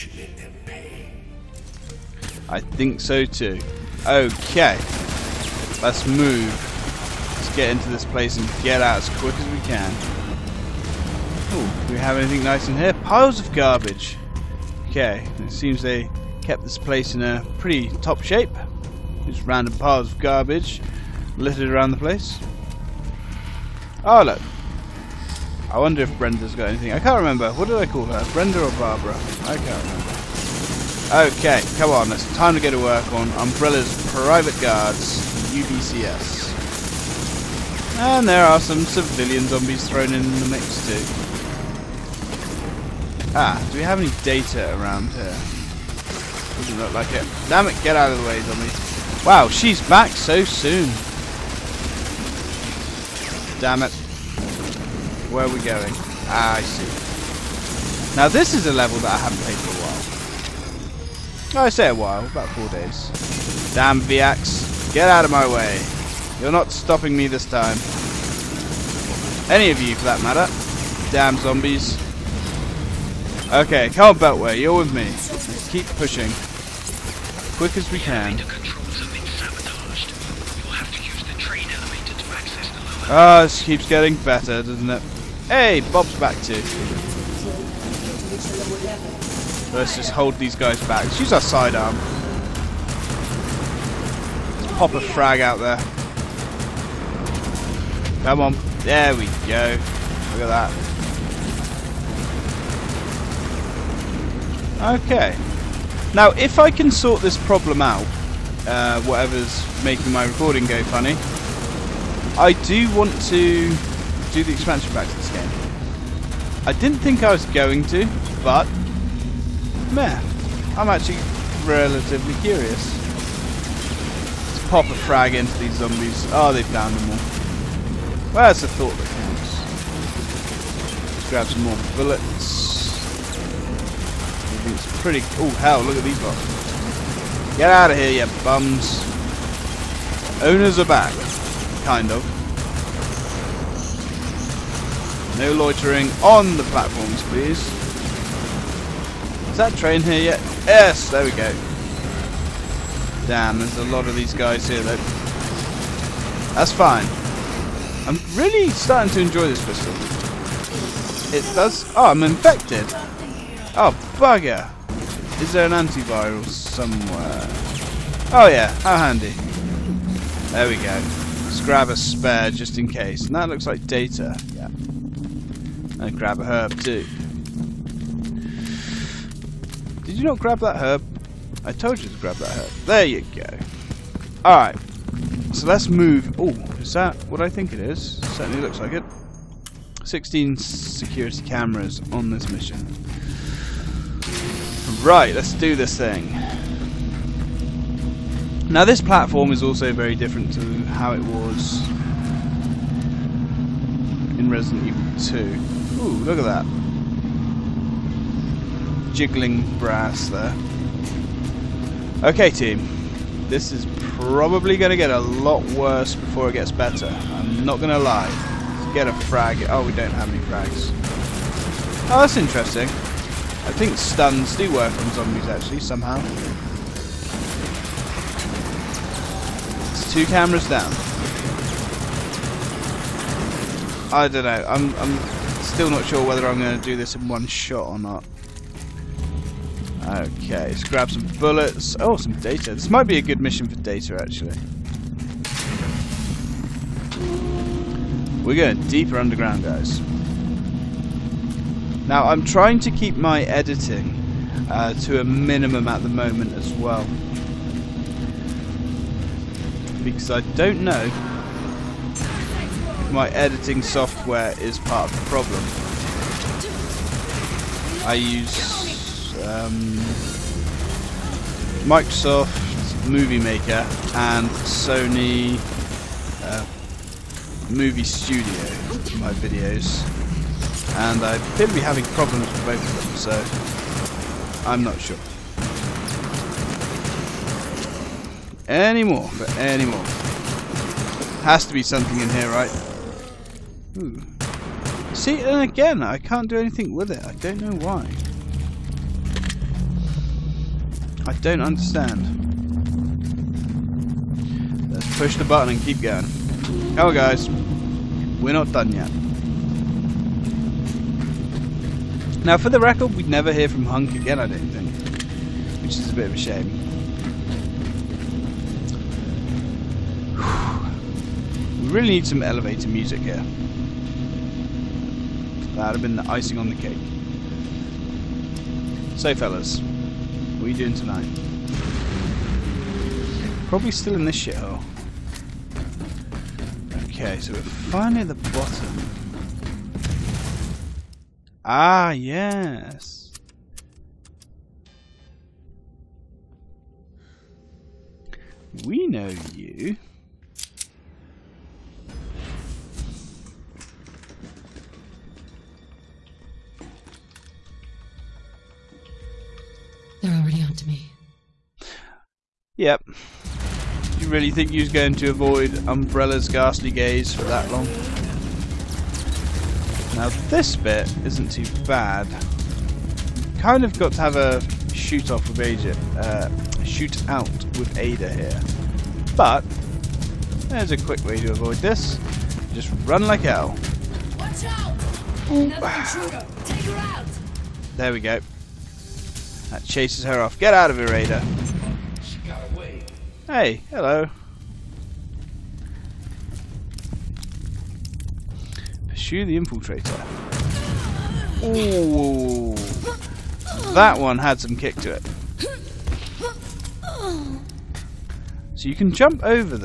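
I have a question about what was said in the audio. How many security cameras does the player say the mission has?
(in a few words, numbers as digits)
16.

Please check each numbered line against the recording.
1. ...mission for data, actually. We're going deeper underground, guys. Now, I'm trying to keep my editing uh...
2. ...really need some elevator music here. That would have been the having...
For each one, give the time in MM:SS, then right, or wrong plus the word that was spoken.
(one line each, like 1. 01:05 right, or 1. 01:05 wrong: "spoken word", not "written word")
1. 04:03 right
2. 05:21 wrong: "icing", not "having".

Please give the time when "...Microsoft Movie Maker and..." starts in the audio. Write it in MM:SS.
04:31.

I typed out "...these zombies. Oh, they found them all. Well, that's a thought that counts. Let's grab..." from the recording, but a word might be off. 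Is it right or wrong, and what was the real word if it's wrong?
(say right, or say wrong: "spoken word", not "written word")
right.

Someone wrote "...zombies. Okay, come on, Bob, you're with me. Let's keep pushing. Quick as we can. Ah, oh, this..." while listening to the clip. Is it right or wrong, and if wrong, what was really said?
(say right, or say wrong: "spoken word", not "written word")
wrong: "Beltway", not "Bob".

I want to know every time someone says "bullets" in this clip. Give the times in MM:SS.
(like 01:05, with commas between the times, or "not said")
02:11, 04:01.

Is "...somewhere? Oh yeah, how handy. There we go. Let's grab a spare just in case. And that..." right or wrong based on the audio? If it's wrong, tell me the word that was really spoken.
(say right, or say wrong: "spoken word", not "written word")
right.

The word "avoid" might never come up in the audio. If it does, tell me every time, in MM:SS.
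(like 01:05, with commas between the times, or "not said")
06:05, 06:21.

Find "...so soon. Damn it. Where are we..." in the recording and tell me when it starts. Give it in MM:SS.
00:50.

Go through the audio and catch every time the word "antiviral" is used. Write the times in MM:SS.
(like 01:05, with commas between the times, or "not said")
02:45.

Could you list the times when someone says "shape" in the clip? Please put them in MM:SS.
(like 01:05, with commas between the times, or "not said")
00:18.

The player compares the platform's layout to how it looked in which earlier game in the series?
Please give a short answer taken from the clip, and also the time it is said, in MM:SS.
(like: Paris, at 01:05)
Resident Evil 2, at 03:24.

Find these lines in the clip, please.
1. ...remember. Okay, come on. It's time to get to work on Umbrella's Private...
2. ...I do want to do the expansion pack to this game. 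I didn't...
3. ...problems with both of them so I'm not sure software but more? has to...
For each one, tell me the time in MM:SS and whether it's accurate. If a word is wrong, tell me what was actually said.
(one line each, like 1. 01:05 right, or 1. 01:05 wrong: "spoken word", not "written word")
1. 00:29 right
2. 01:52 right
3. 04:42 wrong: "anymore", not "software".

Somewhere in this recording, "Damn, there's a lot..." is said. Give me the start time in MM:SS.
02:33.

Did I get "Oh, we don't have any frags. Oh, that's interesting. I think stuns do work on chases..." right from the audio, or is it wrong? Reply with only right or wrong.
wrong.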